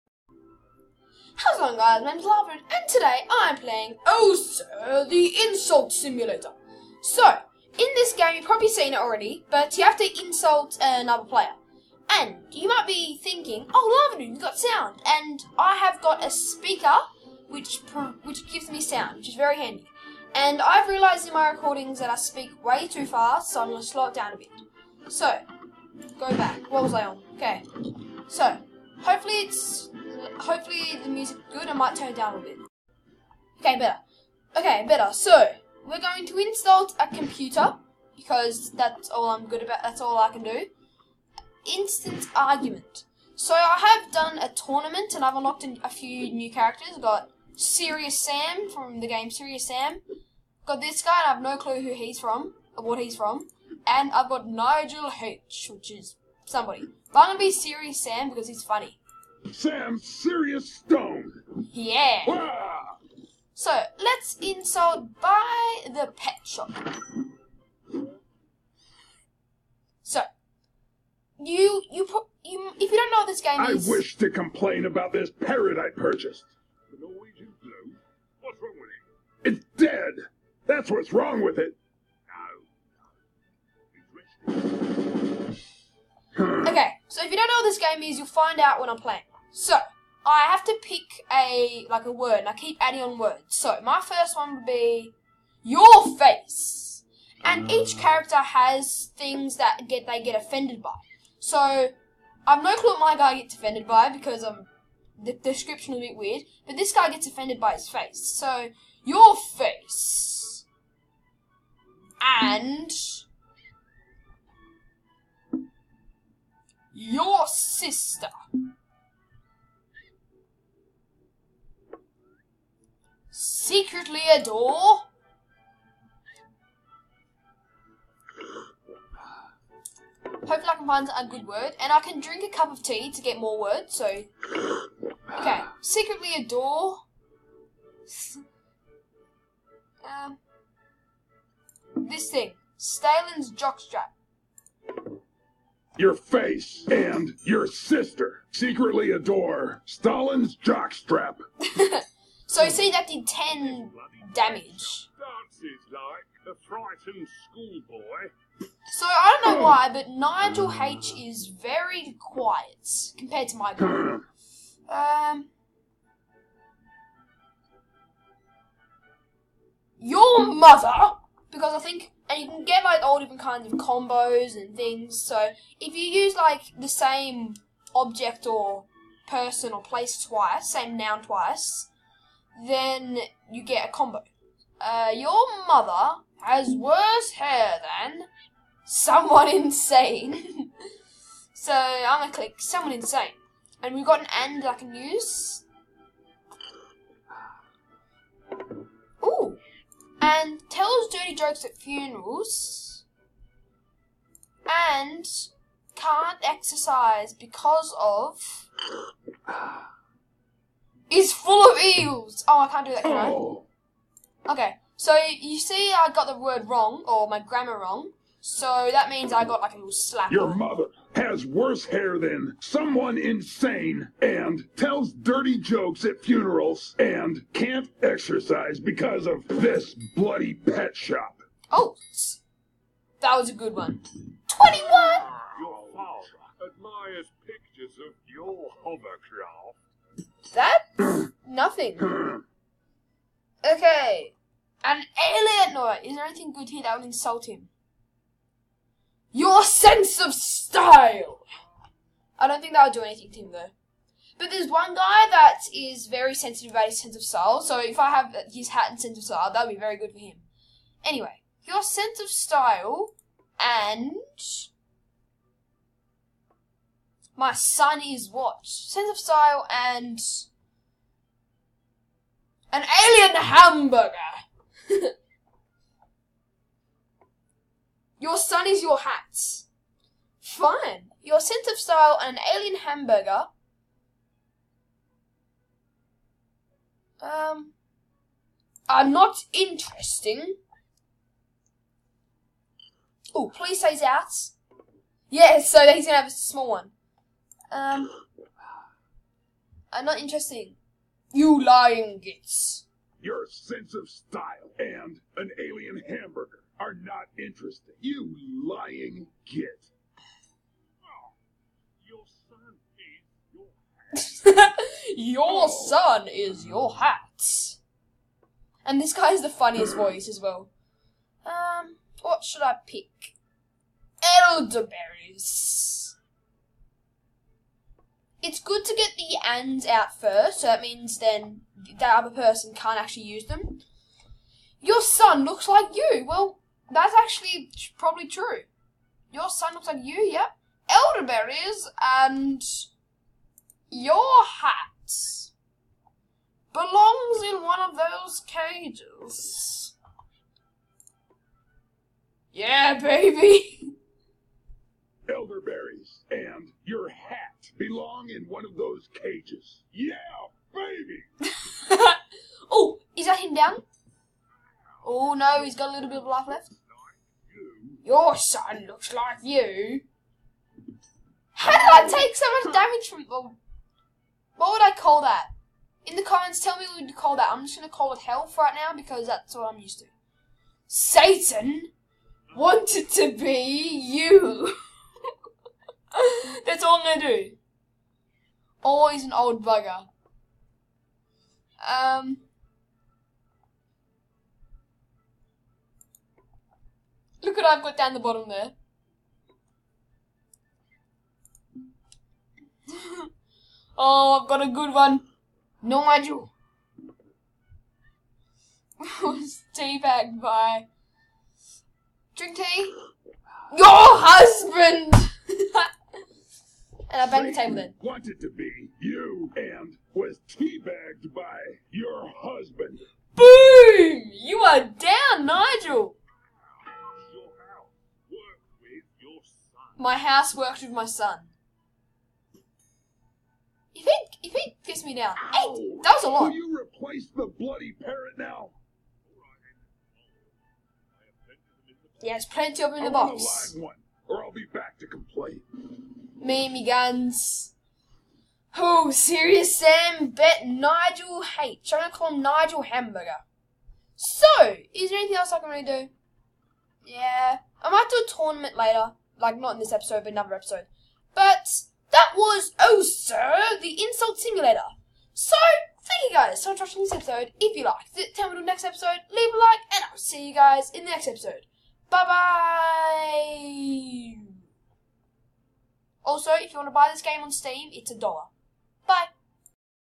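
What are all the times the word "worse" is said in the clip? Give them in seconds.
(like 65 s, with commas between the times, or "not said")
186 s, 221 s.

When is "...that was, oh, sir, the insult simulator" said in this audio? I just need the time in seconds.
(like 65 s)
462 s.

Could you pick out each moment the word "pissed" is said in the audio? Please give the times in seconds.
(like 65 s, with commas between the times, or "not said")
434 s.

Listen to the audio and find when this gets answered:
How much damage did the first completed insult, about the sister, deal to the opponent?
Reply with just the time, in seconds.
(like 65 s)
153 s.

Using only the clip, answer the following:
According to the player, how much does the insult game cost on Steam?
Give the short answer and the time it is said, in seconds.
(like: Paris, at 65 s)
1 dollar, at 478 s.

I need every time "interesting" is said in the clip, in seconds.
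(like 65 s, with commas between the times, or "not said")
289 s, 300 s, 307 s.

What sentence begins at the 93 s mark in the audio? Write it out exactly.
So my first one would be your face, and each ah.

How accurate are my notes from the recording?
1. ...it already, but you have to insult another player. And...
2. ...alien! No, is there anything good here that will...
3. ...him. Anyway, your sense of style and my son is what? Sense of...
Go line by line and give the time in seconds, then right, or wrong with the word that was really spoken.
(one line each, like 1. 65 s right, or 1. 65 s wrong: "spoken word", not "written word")
1. 8 s right
2. 245 s right
3. 260 s right.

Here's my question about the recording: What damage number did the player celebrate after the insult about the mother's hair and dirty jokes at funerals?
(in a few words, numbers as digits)
21.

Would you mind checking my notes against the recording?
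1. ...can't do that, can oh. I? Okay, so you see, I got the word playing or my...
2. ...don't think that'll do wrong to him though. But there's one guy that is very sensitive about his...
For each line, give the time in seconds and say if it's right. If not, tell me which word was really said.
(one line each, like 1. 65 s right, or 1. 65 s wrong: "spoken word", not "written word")
1. 212 s wrong: "wrong", not "playing"
2. 252 s wrong: "anything", not "wrong".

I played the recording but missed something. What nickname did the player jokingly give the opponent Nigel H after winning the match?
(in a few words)
Nigel Hamburger.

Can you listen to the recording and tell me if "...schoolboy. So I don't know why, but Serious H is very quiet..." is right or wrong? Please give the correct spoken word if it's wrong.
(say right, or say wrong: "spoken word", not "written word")
wrong: "Nigel", not "Serious".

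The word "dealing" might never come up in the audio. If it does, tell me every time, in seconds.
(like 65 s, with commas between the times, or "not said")
not said.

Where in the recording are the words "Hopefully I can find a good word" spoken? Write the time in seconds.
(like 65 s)
130 s.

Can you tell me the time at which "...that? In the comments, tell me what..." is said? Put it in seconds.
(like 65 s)
375 s.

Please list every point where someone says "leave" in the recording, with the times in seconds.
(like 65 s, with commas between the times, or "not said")
469 s.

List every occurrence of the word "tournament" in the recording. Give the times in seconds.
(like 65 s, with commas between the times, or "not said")
44 s, 458 s.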